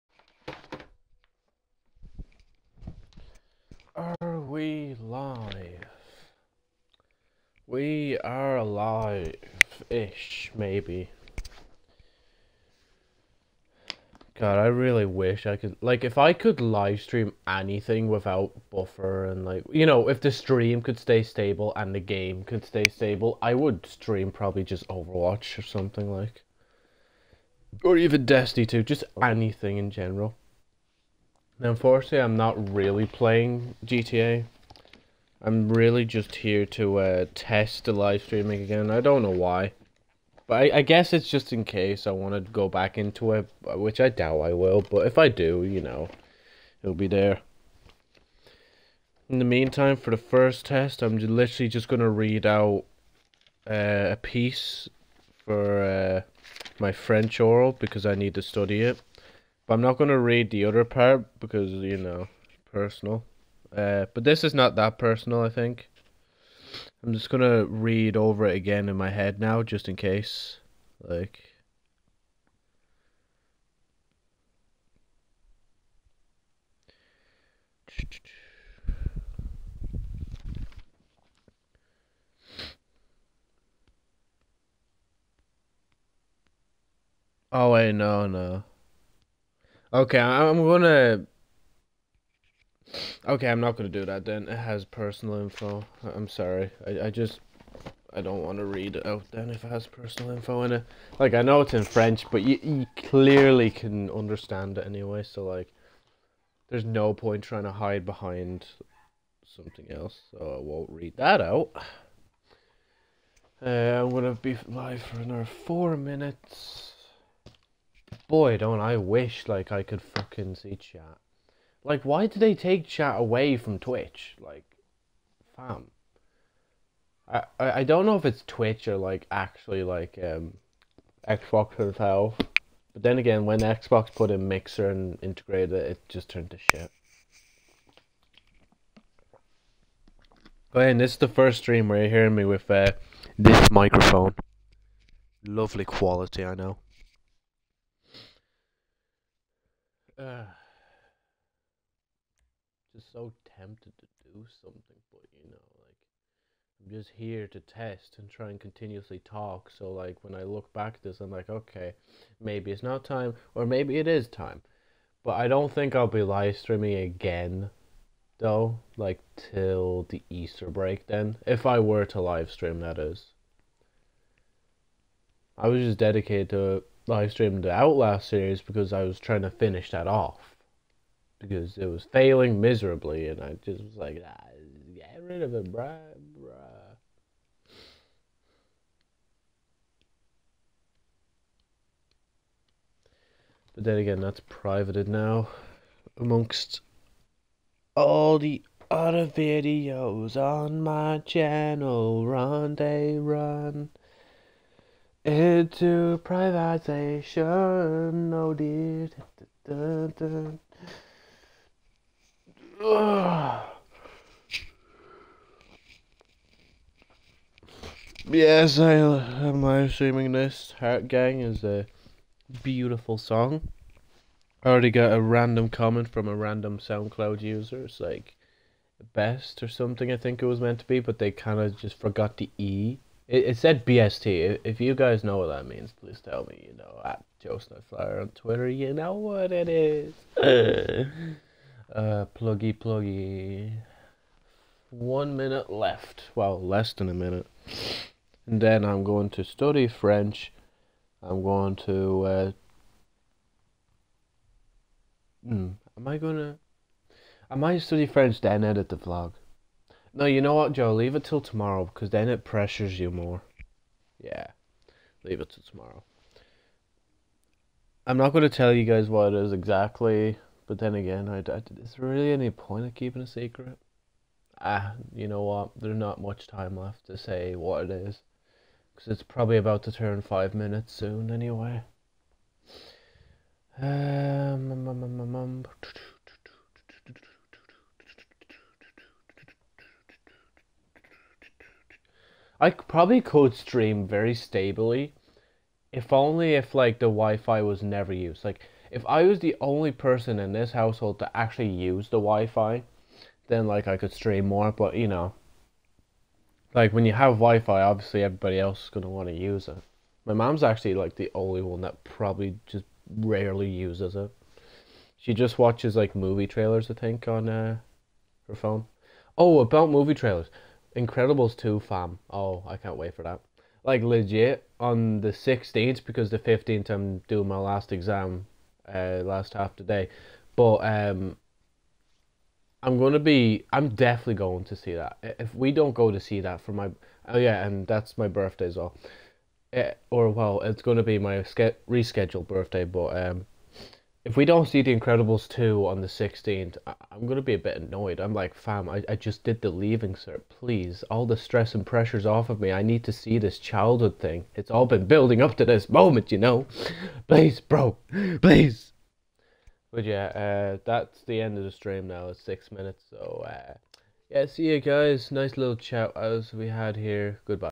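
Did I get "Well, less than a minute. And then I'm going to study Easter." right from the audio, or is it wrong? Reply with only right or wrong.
wrong.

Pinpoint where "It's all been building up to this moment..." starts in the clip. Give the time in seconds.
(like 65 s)
354 s.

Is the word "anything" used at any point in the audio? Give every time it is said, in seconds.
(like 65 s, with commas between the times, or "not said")
17 s, 29 s.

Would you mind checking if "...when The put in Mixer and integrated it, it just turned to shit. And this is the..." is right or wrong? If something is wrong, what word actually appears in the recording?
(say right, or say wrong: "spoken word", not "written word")
wrong: "Xbox", not "The".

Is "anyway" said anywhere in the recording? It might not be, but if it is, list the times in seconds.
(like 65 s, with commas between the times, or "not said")
104 s, 281 s.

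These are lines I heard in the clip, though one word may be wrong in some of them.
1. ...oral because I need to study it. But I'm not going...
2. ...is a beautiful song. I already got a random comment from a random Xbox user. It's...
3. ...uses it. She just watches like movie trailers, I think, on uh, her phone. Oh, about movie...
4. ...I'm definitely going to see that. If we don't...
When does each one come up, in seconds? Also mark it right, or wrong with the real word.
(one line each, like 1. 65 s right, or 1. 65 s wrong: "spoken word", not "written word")
1. 57 s right
2. 221 s wrong: "SoundCloud", not "Xbox"
3. 313 s right
4. 333 s right.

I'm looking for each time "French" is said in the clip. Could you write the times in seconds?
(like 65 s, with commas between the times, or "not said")
56 s, 101 s, 249 s, 258 s.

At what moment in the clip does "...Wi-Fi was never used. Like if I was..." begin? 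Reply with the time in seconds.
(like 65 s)
297 s.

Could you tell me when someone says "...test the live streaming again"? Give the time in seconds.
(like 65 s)
37 s.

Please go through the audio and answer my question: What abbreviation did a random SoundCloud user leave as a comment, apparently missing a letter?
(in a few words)
BST.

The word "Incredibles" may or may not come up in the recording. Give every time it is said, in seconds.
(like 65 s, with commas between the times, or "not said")
320 s, 344 s.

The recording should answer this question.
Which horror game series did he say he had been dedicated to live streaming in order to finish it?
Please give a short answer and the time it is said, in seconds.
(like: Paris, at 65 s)
Outlast, at 177 s.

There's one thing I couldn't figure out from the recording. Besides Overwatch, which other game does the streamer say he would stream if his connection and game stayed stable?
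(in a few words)
Destiny 2.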